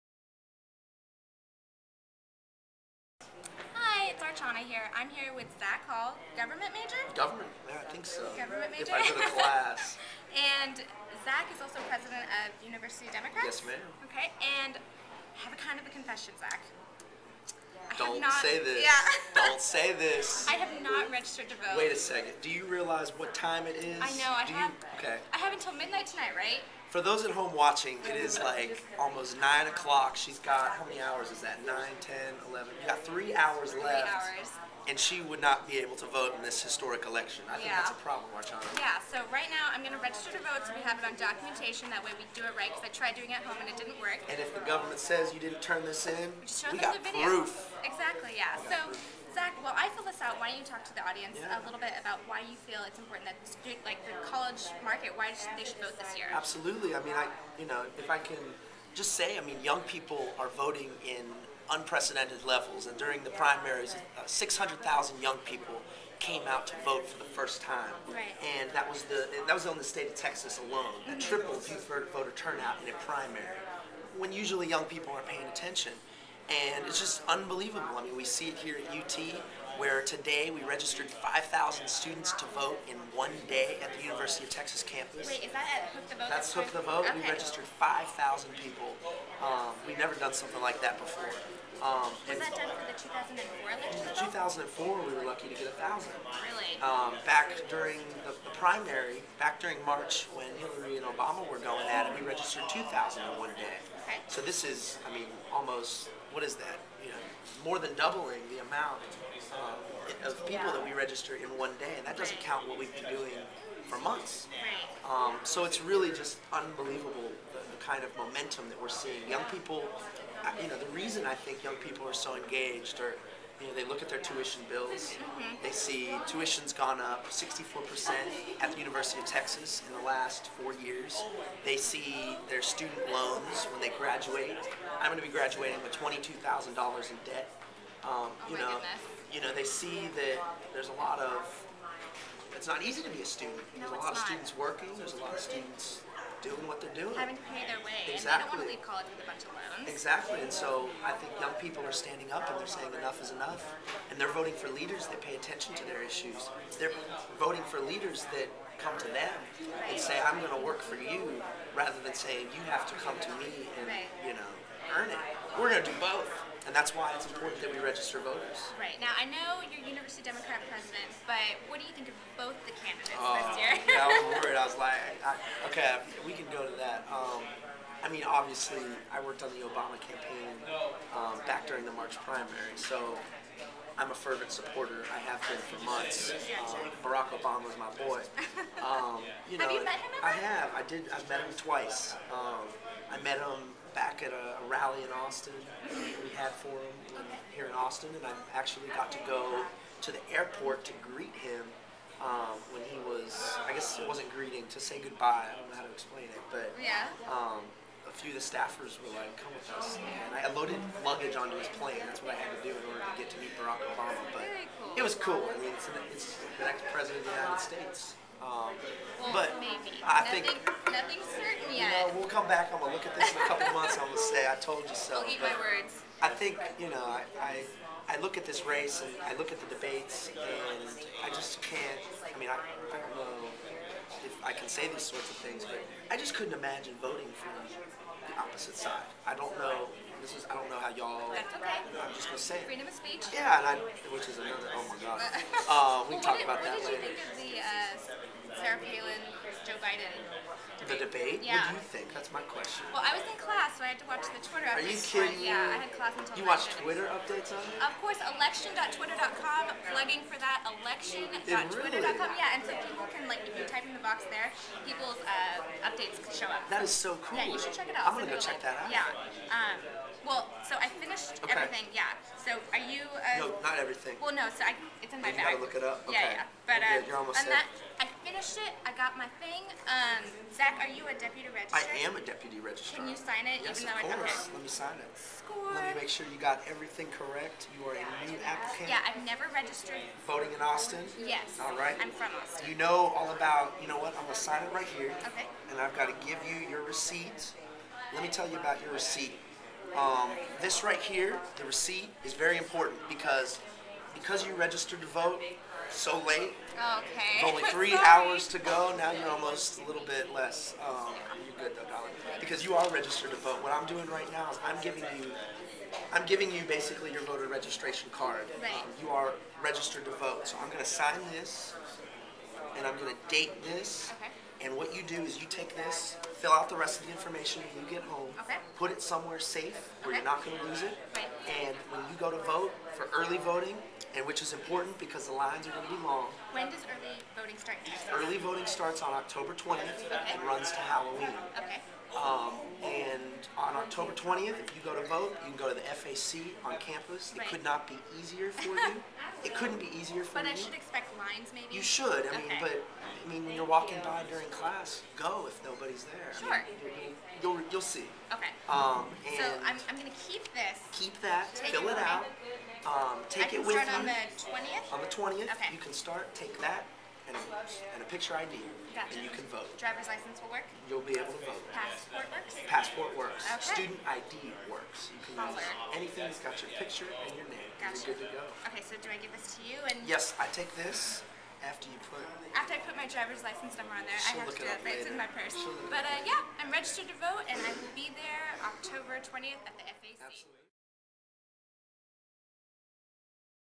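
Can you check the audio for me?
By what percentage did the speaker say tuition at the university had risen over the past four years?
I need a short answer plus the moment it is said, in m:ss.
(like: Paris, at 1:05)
64%, at 2:07.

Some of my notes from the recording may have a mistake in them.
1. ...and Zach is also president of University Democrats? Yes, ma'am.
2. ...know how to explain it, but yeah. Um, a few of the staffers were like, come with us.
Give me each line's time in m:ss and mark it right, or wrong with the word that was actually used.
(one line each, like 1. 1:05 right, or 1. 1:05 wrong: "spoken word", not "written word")
1. 0:10 right
2. 3:25 right.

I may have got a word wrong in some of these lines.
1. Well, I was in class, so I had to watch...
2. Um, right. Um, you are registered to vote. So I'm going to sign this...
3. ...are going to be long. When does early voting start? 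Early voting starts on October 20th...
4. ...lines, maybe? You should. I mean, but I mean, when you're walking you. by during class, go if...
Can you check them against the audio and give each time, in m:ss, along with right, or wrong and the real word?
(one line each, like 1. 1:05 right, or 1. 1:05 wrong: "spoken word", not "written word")
1. 4:12 right
2. 5:18 right
3. 5:35 right
4. 5:51 right.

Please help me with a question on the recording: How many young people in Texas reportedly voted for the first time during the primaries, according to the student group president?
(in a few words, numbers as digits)
600,000.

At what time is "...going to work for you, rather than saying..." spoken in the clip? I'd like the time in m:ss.
2:40.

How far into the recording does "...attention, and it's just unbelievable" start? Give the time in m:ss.
1:15.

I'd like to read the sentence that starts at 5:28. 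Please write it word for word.
put it somewhere safe where okay.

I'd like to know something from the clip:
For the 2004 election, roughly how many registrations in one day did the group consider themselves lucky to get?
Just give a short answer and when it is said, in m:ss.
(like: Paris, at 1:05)
1,000, at 1:35.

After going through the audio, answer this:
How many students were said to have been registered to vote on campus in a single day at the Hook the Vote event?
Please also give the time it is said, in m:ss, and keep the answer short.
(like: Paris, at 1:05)
5,000, at 1:21.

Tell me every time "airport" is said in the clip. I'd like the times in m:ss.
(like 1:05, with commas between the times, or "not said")
3:20.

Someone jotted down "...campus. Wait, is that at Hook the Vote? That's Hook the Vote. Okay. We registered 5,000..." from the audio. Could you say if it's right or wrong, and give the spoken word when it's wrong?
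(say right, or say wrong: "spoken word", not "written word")
right.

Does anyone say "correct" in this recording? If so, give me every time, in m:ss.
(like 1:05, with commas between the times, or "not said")
4:47.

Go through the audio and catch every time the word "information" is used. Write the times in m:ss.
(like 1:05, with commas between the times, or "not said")
5:27.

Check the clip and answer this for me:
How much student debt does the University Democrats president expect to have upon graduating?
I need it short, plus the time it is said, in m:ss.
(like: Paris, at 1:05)
$22,000, at 2:15.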